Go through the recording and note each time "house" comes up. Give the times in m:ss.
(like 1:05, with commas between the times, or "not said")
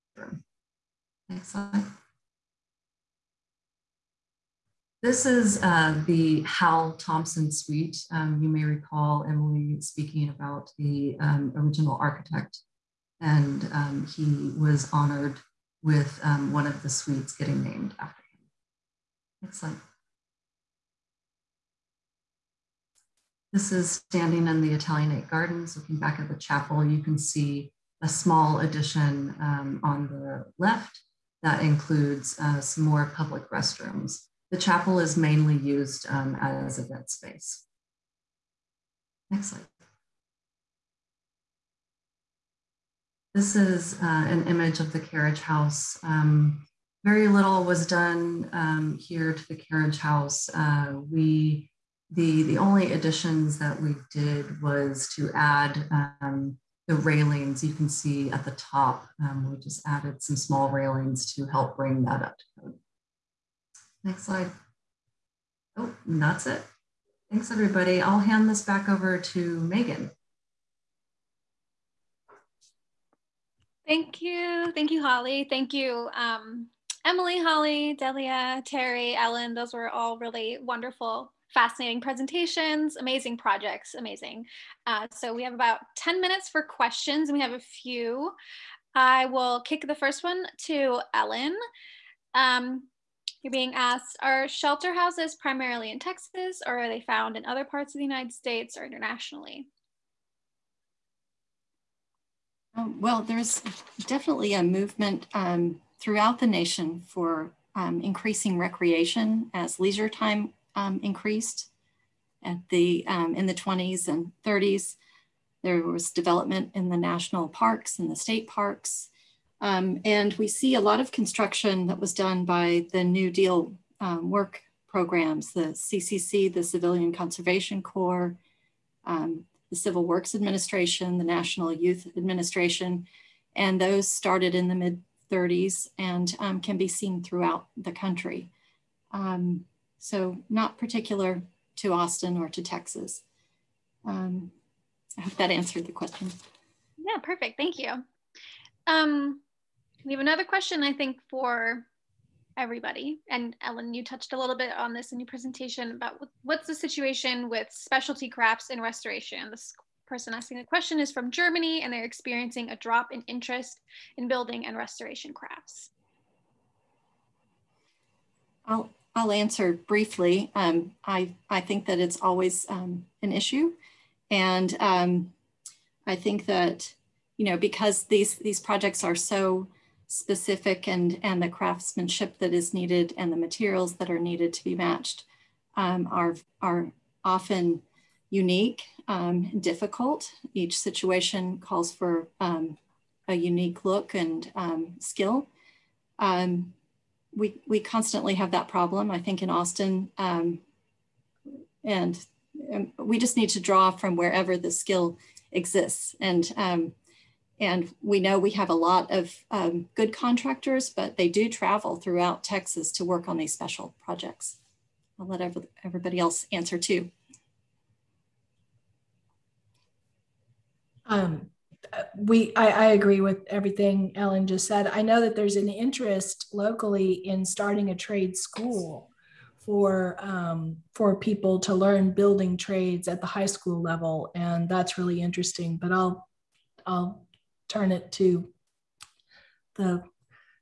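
0:45, 0:49, 1:34.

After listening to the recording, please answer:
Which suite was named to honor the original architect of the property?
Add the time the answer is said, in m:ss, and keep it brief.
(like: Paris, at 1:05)
Hal Thomson suite, at 0:06.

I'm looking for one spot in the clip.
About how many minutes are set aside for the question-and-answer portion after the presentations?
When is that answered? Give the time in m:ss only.
1:25.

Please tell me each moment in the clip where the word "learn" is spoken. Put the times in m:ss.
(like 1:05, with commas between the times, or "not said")
3:51.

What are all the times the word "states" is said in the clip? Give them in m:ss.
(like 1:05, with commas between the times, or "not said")
1:38, 1:58.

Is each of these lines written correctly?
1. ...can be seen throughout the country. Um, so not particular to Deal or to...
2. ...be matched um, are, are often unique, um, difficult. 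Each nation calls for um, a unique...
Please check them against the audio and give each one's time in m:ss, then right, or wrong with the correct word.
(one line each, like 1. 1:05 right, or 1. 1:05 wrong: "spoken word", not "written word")
1. 2:16 wrong: "Austin", not "Deal"
2. 3:04 wrong: "situation", not "nation".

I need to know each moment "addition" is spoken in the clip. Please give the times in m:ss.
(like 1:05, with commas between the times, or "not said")
0:28, 0:52.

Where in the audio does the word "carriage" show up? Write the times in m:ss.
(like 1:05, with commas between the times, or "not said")
0:44, 0:49.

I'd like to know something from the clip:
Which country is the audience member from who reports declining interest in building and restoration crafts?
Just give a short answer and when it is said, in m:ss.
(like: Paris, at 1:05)
Germany, at 2:41.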